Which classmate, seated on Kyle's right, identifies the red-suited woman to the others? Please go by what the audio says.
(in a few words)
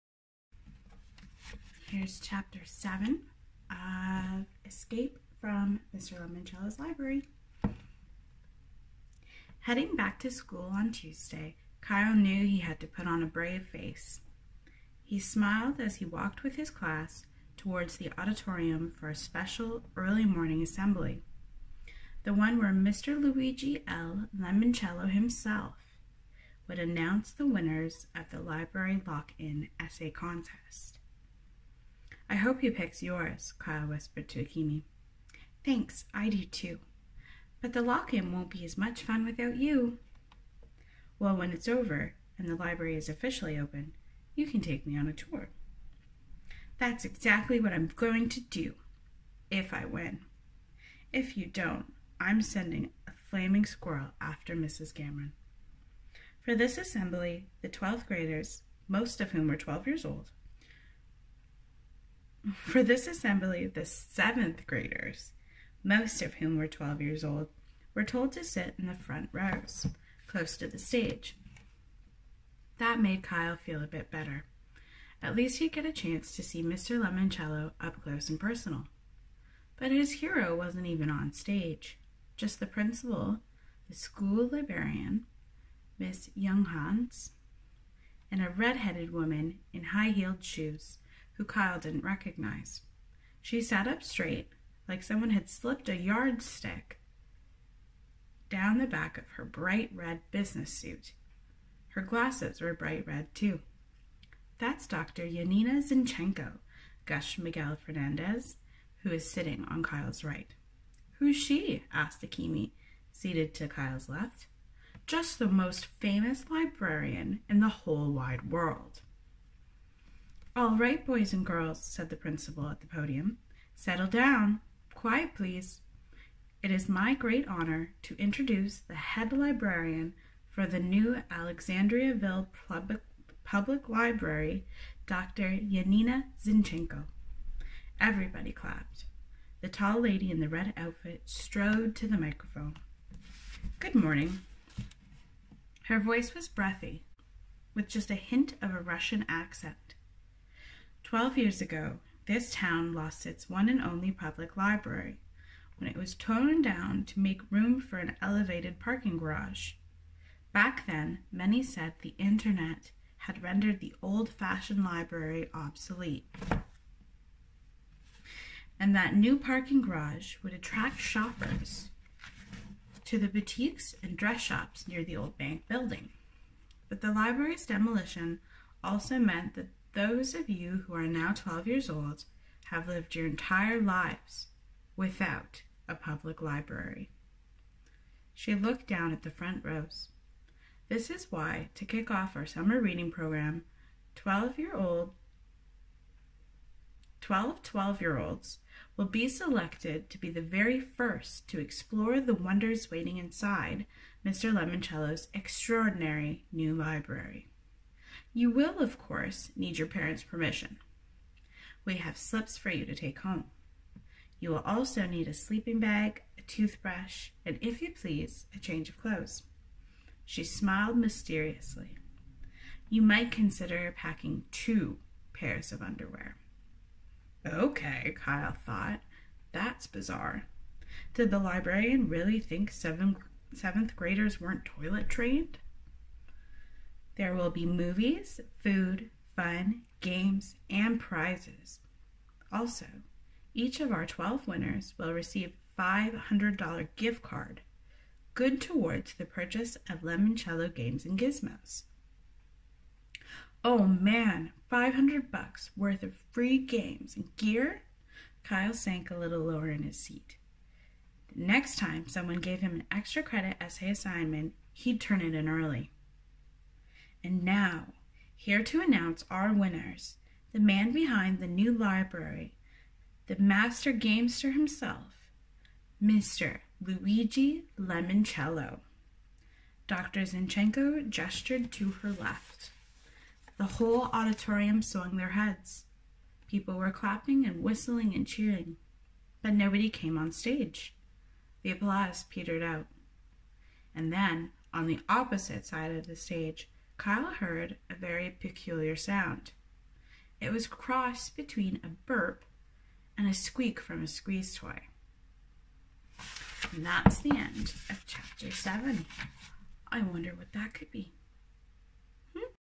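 Miguel Fernandez.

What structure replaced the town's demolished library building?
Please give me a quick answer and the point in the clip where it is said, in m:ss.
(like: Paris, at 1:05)
an elevated parking garage, at 2:38.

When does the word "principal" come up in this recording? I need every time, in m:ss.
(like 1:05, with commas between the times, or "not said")
1:22, 2:02.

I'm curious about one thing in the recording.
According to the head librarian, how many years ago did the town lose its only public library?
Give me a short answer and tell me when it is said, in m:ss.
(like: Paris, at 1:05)
12, at 2:31.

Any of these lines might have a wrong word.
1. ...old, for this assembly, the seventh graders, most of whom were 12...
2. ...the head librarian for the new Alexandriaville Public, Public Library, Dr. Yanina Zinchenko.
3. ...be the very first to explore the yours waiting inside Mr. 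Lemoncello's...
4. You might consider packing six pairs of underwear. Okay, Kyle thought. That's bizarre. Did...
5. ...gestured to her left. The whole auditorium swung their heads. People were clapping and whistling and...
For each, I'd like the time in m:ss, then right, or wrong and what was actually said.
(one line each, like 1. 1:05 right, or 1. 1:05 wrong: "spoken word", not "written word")
1. 1:00 right
2. 2:08 right
3. 3:20 wrong: "wonders", not "yours"
4. 3:42 wrong: "two", not "six"
5. 4:41 right.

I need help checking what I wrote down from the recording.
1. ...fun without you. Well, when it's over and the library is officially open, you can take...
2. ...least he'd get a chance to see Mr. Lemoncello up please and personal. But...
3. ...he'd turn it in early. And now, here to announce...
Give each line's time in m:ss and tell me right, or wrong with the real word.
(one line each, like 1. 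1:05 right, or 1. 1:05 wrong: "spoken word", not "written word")
1. 0:39 right
2. 1:15 wrong: "close", not "please"
3. 4:24 right.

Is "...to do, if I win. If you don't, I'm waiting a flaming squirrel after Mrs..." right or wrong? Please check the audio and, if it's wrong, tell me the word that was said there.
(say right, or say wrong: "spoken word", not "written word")
wrong: "sending", not "waiting".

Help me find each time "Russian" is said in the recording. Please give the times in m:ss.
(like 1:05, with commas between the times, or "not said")
2:28.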